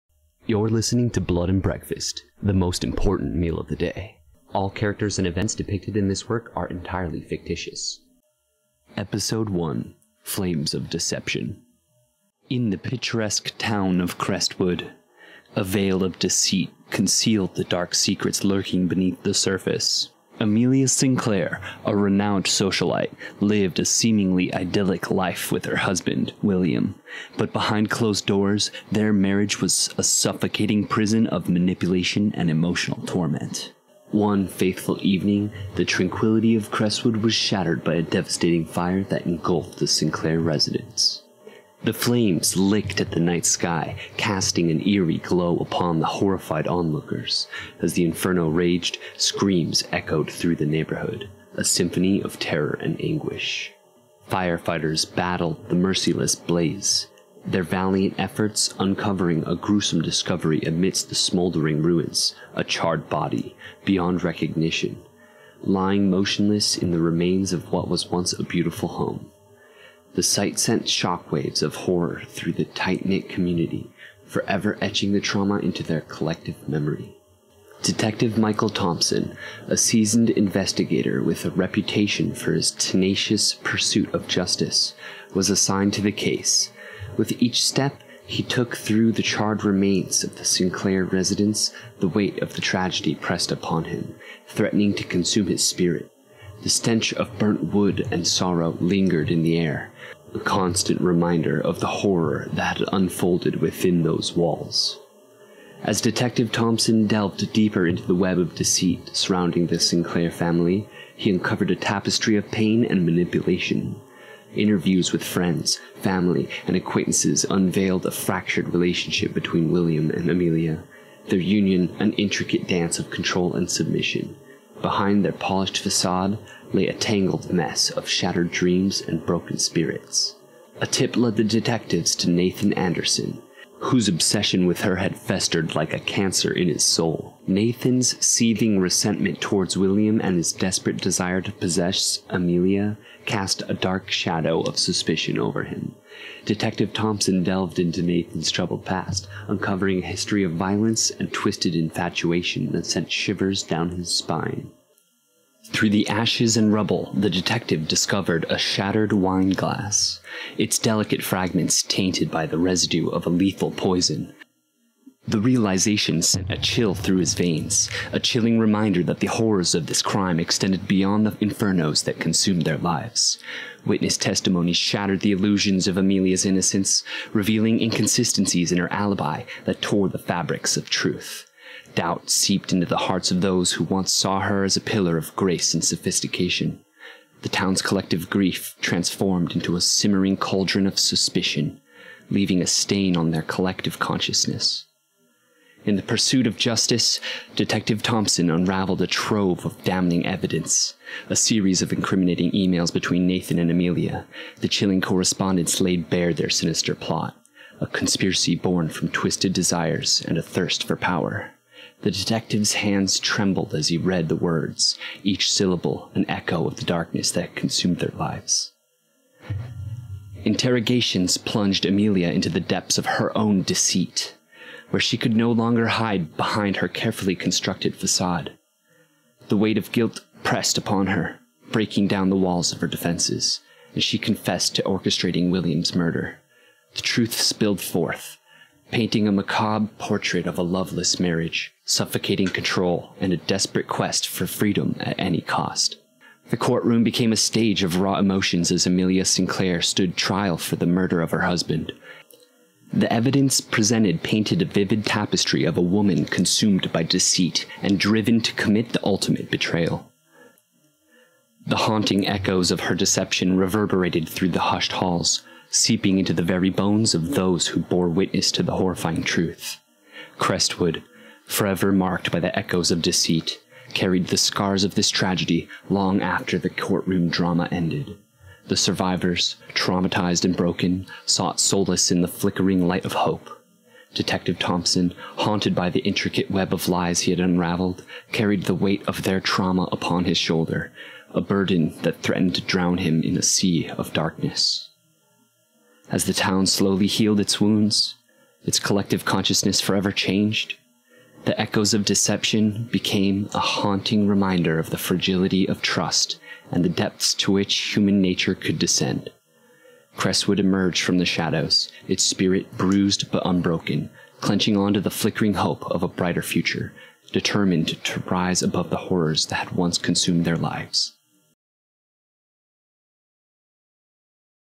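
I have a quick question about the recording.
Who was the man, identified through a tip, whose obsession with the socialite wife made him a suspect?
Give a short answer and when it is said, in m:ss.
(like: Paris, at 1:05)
Nathan Anderson, at 2:12.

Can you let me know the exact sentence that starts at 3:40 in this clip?
Interrogations plunged Amelia into the depths of her own deceit where she could no longer hide behind her carefully constructed facade.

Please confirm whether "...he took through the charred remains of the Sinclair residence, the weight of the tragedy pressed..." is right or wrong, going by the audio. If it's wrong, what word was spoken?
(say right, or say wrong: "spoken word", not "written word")
right.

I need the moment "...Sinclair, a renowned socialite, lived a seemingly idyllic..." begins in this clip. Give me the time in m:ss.
0:20.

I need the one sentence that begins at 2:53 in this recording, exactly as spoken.
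Witness testimony shattered the illusions of Amelia's innocence, revealing inconsistencies in her alibi that tore the fabrics of truth.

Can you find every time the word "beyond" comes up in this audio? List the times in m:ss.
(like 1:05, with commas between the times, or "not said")
1:03, 2:50.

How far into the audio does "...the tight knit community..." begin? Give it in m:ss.
1:12.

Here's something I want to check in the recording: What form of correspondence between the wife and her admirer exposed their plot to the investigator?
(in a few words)
Emails.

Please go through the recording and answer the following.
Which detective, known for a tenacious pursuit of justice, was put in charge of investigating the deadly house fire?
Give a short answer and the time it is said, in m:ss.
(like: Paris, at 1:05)
Michael Thompson, at 1:18.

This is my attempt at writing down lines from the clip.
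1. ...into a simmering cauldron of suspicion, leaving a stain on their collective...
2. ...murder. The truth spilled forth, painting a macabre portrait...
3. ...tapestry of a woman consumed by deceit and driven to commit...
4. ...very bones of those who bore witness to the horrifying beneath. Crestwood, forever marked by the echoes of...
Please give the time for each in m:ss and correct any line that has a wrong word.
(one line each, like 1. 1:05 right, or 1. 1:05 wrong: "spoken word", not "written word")
1. 3:09 right
2. 3:55 right
3. 4:15 right
4. 4:26 wrong: "truth", not "beneath".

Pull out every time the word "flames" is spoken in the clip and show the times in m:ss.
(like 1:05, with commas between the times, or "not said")
0:10, 0:41.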